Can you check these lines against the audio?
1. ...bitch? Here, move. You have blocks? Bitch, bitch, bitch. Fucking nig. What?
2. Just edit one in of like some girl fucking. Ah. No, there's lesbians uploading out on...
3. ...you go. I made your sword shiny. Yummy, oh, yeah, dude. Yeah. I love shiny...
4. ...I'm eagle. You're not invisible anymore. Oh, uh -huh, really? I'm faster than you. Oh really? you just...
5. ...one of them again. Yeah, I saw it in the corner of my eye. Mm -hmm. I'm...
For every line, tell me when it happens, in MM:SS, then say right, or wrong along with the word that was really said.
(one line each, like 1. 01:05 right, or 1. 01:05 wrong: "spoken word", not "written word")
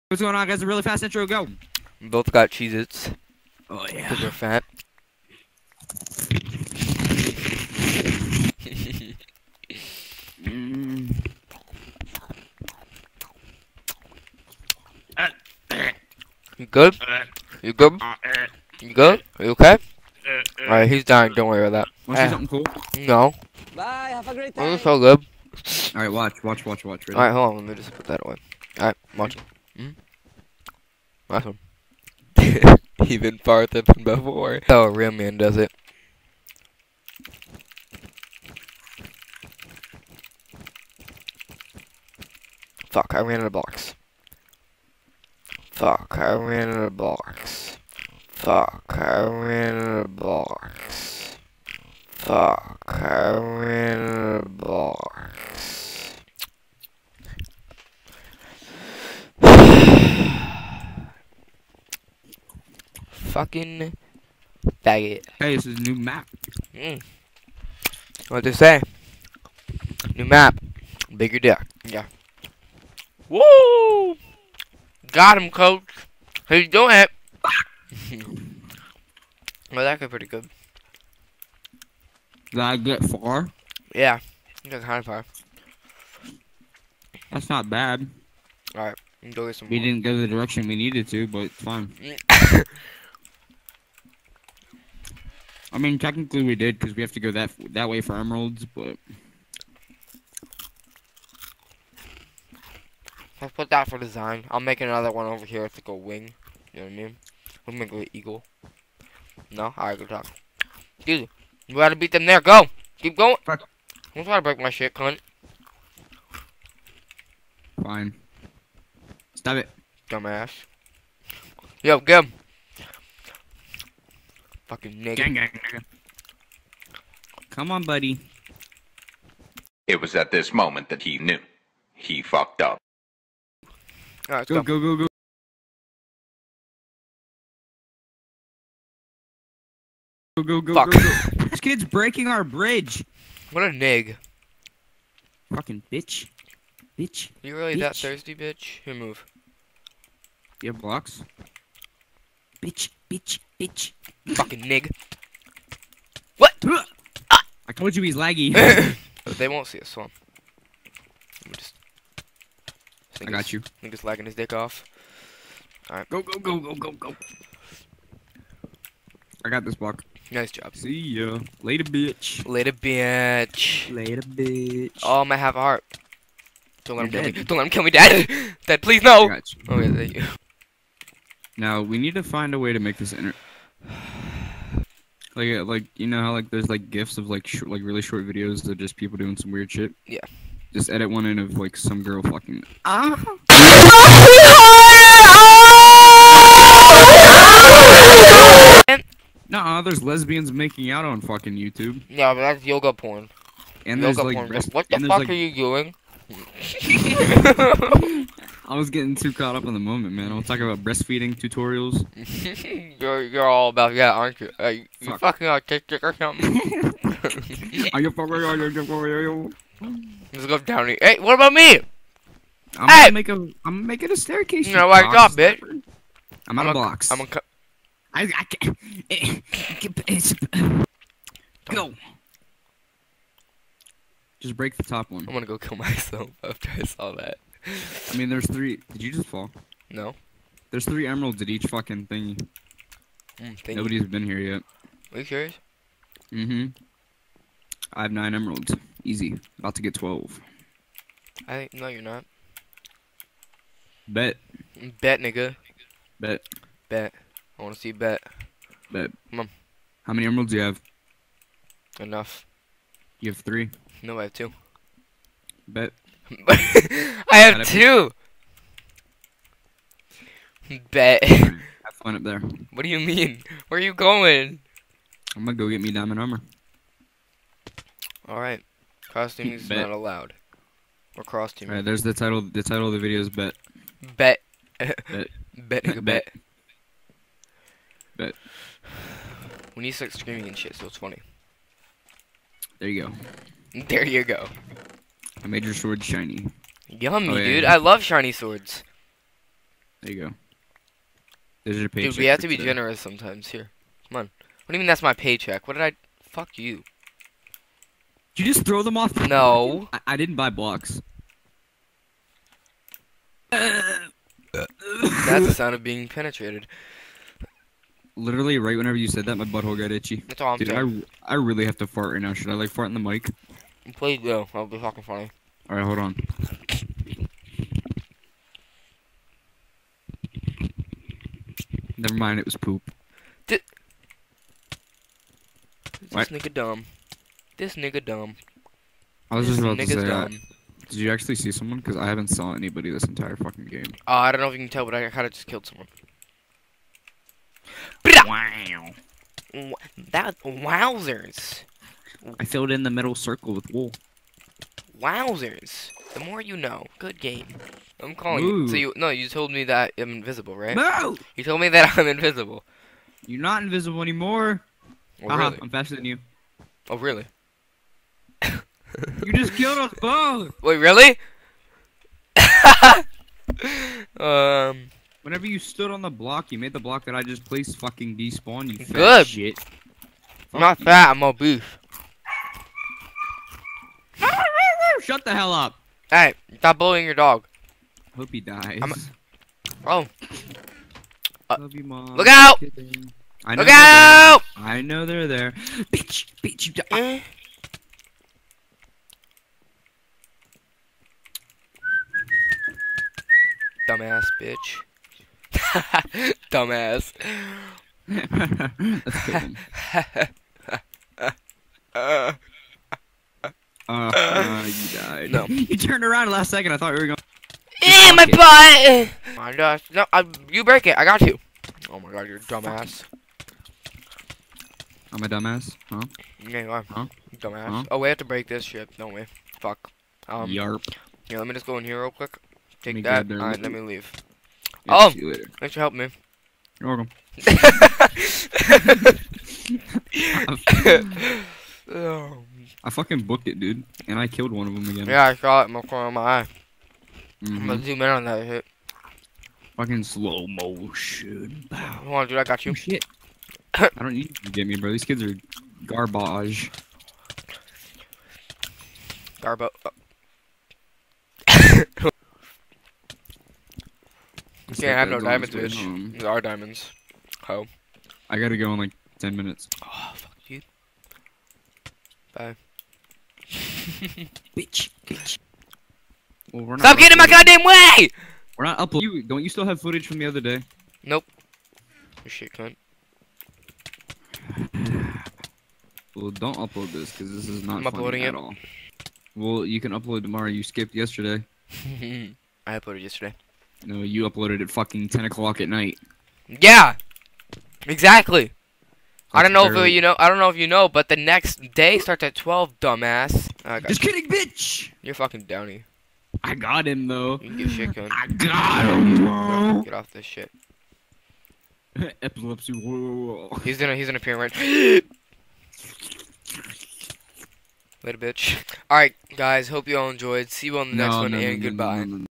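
1. 02:28 right
2. 03:10 wrong: "making", not "uploading"
3. 04:54 right
4. 06:01 wrong: "invisible", not "eagle"
5. 07:24 right.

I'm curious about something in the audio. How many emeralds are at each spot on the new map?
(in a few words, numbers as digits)
3.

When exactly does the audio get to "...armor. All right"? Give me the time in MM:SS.
04:36.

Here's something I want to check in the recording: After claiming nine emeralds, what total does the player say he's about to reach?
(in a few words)
12.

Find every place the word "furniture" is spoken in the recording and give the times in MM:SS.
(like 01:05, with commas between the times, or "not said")
not said.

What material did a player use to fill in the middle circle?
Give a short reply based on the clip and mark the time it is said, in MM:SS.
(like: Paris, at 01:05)
wool, at 05:53.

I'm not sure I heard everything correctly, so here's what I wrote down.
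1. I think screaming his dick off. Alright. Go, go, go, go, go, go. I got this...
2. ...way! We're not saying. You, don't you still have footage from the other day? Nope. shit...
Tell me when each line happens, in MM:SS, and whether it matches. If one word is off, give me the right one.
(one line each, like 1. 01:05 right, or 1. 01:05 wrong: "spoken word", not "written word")
1. 02:43 wrong: "lagging", not "screaming"
2. 07:57 wrong: "uploading", not "saying".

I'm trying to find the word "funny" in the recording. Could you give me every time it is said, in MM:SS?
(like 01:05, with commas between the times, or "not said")
04:50, 05:25.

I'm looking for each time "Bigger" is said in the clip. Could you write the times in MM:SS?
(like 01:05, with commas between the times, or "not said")
01:11.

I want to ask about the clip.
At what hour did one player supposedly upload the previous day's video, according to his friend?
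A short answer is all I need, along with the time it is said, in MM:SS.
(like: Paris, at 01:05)
10 o'clock, at 08:15.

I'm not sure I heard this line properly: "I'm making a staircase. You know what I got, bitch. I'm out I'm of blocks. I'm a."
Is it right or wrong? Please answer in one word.
right.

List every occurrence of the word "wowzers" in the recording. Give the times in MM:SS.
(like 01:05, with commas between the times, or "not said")
05:50, 05:54.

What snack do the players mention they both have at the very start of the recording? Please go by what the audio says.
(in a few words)
Cheez Its.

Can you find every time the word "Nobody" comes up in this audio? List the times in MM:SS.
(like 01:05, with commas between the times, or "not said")
04:03.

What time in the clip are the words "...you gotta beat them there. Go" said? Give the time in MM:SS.
01:51.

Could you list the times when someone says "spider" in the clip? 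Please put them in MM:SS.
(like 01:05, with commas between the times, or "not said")
not said.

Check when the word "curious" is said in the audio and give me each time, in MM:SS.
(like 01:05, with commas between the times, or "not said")
04:05.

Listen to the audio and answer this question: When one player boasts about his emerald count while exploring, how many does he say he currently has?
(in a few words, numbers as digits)
9.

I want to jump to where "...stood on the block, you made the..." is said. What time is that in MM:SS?
06:15.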